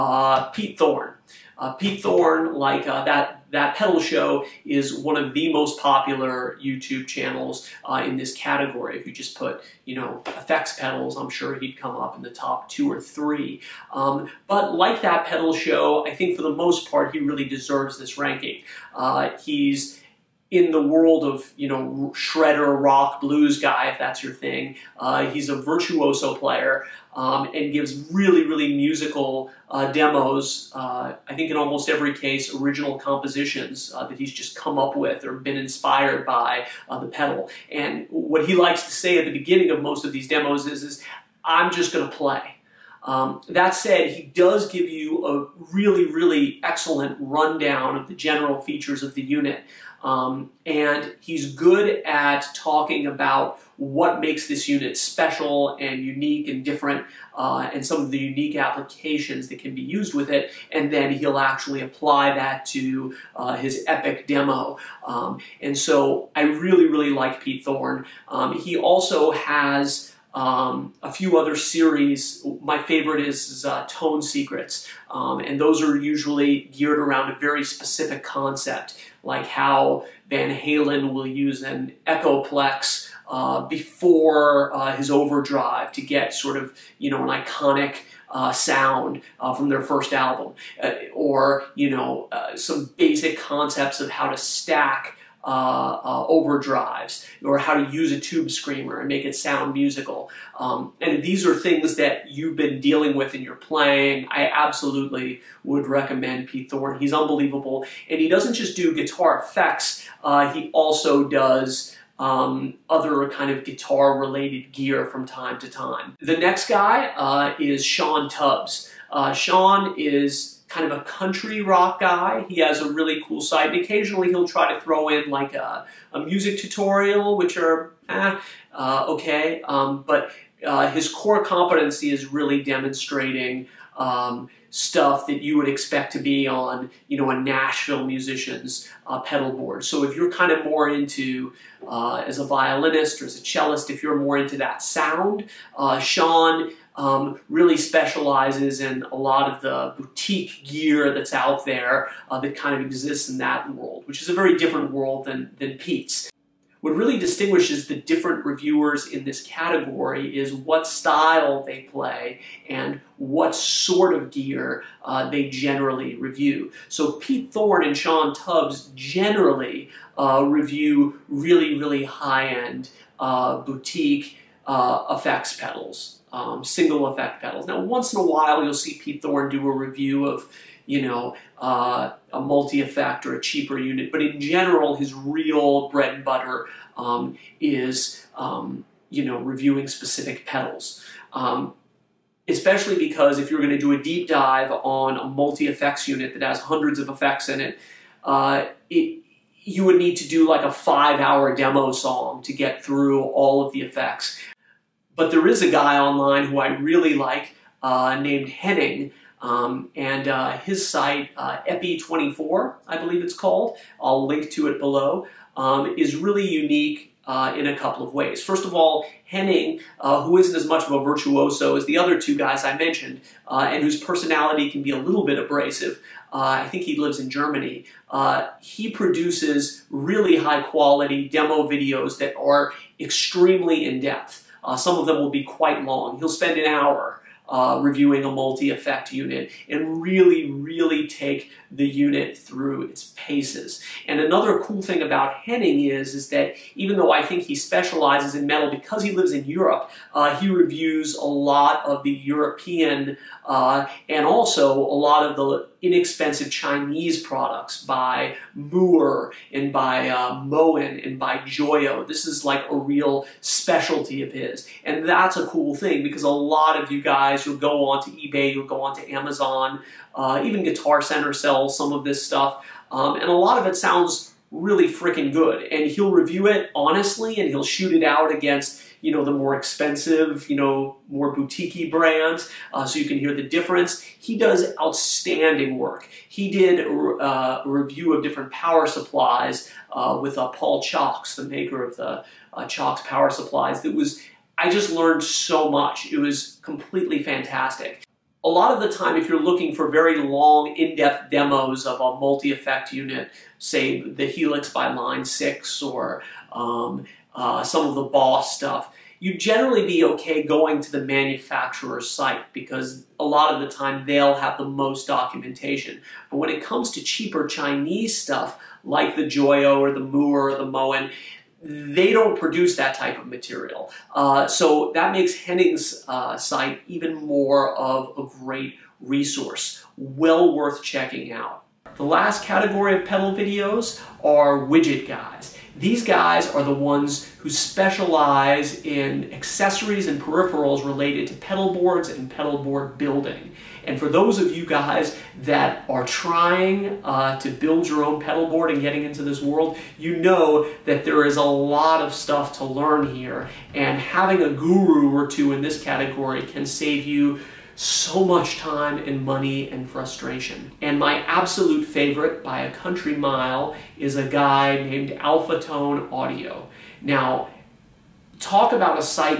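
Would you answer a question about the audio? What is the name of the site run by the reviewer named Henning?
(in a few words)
Epi24.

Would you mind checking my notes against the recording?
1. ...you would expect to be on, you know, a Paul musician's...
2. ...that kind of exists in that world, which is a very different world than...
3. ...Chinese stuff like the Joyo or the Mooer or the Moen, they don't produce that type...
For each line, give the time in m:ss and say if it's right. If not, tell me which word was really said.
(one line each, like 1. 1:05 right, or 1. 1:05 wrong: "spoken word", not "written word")
1. 2:15 wrong: "Nashville", not "Paul"
2. 2:32 right
3. 5:17 right.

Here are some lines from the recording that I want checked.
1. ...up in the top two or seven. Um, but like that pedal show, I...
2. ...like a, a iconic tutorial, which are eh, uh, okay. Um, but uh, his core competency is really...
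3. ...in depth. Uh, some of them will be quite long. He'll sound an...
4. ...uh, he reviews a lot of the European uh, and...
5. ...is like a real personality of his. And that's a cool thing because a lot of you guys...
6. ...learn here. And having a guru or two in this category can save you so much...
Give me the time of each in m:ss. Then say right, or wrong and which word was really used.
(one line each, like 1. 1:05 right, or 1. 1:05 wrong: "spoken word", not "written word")
1. 0:11 wrong: "three", not "seven"
2. 2:05 wrong: "music", not "iconic"
3. 3:53 wrong: "spend", not "sound"
4. 4:10 right
5. 4:22 wrong: "specialty", not "personality"
6. 5:52 right.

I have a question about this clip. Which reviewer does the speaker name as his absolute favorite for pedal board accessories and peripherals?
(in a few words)
Alpha Tone Audio.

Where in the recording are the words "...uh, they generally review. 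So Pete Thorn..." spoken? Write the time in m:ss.
2:45.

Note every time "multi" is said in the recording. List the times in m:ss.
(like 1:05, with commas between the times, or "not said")
3:02, 3:15, 3:58, 5:02.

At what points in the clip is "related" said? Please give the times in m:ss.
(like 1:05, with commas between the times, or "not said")
1:54, 5:40.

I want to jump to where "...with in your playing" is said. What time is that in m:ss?
1:43.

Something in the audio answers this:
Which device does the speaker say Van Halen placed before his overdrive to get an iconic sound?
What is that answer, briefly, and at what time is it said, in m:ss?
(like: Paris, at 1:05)
Echoplex, at 1:22.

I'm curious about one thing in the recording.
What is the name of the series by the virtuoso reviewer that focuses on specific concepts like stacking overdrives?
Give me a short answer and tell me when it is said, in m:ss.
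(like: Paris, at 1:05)
Tone Secrets, at 1:13.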